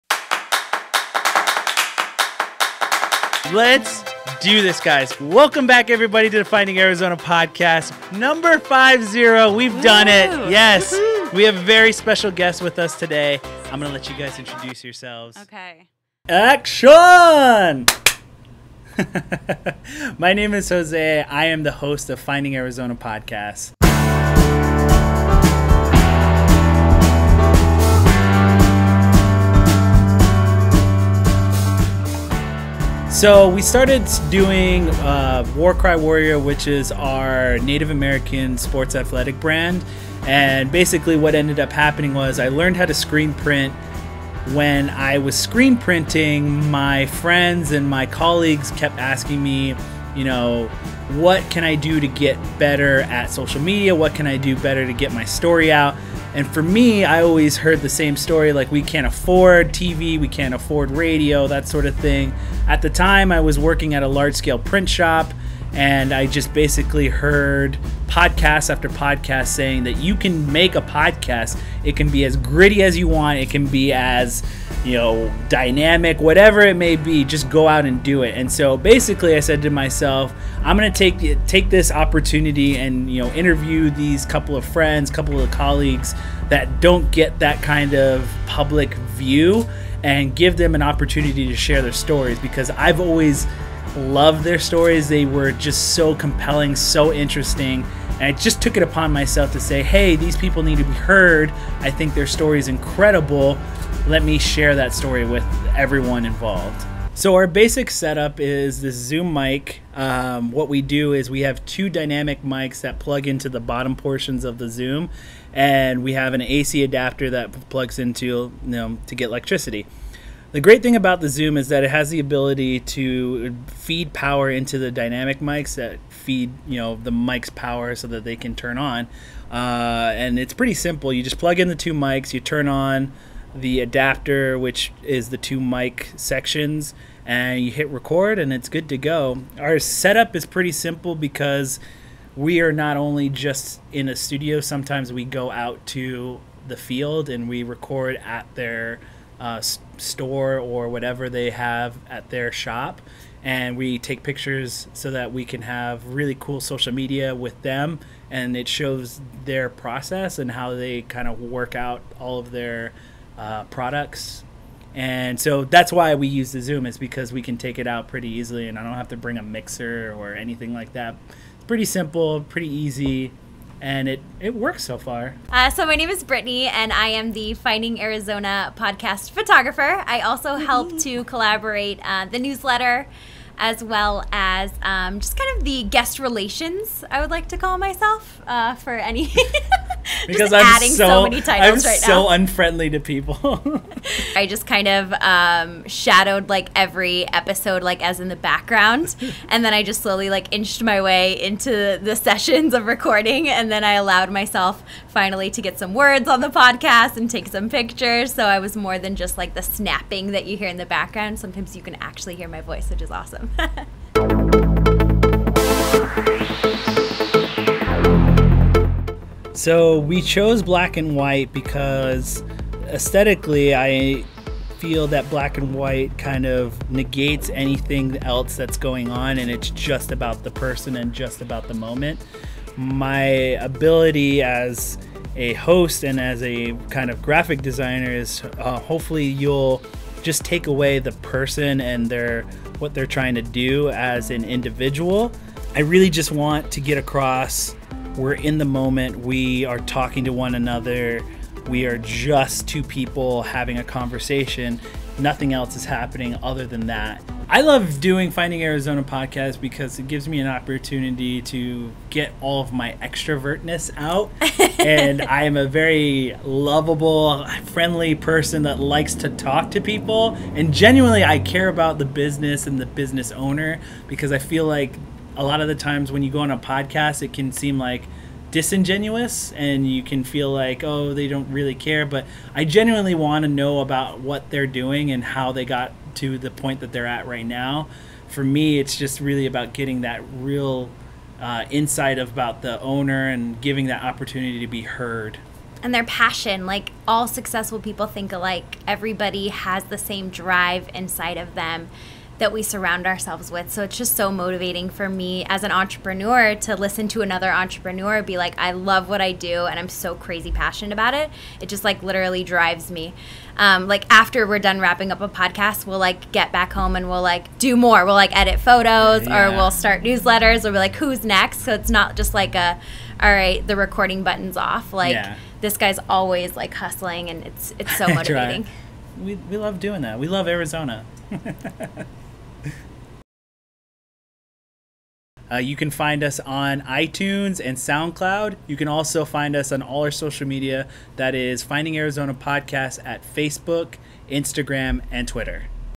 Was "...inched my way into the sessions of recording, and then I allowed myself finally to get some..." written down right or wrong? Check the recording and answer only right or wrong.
right.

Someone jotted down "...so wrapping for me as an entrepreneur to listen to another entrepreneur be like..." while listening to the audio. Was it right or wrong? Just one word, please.
wrong.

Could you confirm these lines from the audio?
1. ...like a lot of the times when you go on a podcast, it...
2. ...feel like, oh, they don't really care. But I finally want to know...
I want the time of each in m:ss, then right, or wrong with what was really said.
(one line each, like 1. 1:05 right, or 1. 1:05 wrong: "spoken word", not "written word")
1. 4:34 right
2. 4:40 wrong: "genuinely", not "finally".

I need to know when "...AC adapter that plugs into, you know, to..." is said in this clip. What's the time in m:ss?
1:56.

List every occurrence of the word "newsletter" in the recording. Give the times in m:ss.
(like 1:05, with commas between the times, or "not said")
3:02, 5:20.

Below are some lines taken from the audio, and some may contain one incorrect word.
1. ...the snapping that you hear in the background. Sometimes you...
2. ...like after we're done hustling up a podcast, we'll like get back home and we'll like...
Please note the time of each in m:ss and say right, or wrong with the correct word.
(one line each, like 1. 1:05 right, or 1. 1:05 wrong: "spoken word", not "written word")
1. 3:29 right
2. 5:13 wrong: "wrapping", not "hustling".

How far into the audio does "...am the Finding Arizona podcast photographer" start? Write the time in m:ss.
2:57.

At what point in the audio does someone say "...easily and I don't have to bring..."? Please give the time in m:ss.
2:48.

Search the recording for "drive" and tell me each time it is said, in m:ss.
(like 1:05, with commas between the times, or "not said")
5:00, 5:12.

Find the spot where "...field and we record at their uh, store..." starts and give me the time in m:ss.
2:26.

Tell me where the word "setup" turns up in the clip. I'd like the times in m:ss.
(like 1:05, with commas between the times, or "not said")
1:47, 2:19.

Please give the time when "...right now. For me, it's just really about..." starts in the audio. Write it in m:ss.
4:47.